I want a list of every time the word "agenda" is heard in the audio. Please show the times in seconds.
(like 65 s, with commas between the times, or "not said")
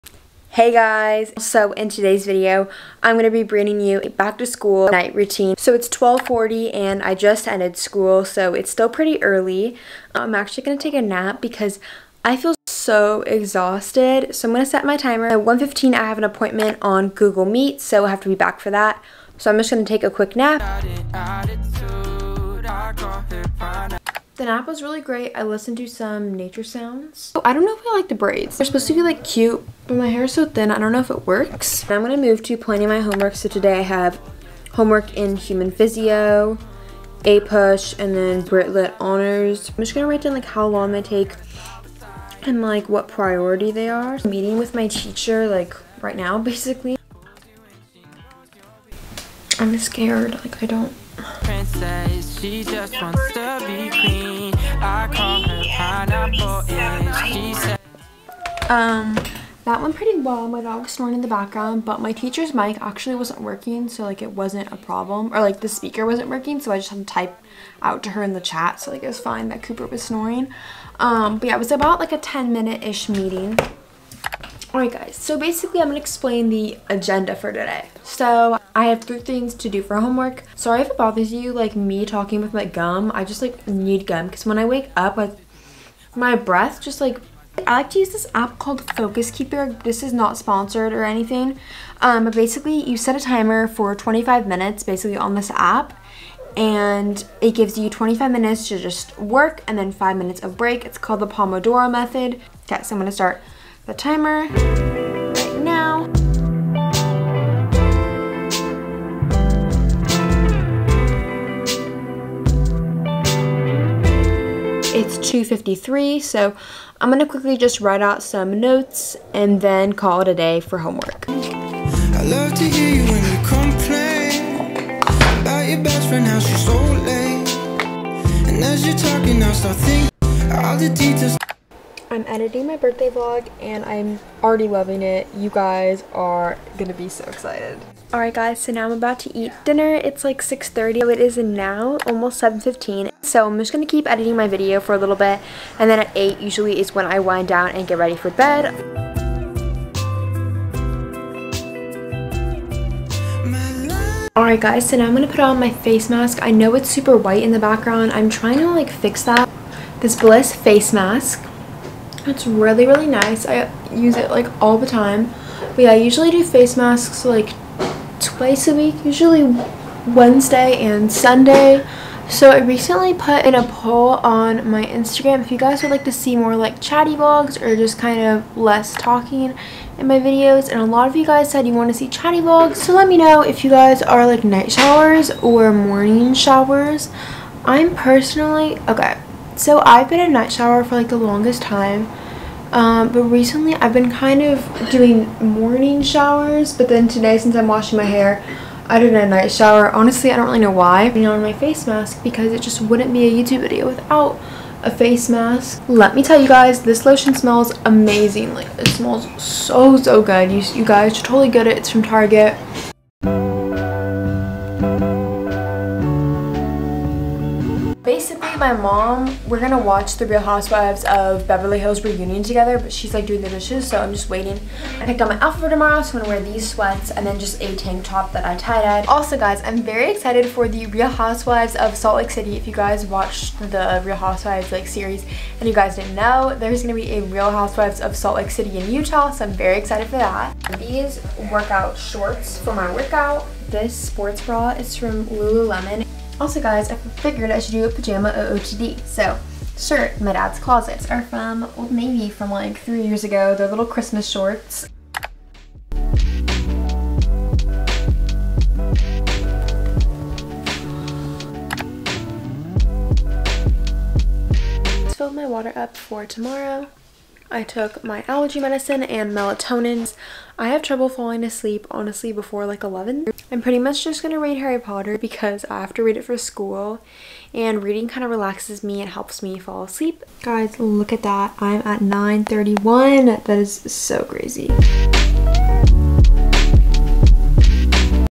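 76 s.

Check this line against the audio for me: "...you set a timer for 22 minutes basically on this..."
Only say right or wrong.
wrong.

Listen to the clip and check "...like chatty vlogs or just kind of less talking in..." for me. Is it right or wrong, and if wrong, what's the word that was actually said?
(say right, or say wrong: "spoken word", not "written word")
right.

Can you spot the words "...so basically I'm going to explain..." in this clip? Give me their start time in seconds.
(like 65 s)
75 s.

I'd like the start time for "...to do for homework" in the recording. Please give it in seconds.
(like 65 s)
79 s.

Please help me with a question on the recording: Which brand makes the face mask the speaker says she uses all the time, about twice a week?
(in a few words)
Bliss.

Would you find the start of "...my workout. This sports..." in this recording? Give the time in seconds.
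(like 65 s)
242 s.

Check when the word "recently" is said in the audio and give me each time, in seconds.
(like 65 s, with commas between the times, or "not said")
172 s, 193 s.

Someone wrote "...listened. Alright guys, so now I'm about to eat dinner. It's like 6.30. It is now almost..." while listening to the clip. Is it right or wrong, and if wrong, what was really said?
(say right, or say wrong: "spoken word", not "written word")
wrong: "excited", not "listened".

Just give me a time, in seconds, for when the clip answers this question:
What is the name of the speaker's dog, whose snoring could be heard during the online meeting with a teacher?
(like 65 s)
69 s.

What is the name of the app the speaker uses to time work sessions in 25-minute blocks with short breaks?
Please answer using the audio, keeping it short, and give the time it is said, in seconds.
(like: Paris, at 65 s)
Focus Keeper, at 88 s.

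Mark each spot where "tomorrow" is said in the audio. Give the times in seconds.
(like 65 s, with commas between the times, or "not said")
225 s, 266 s.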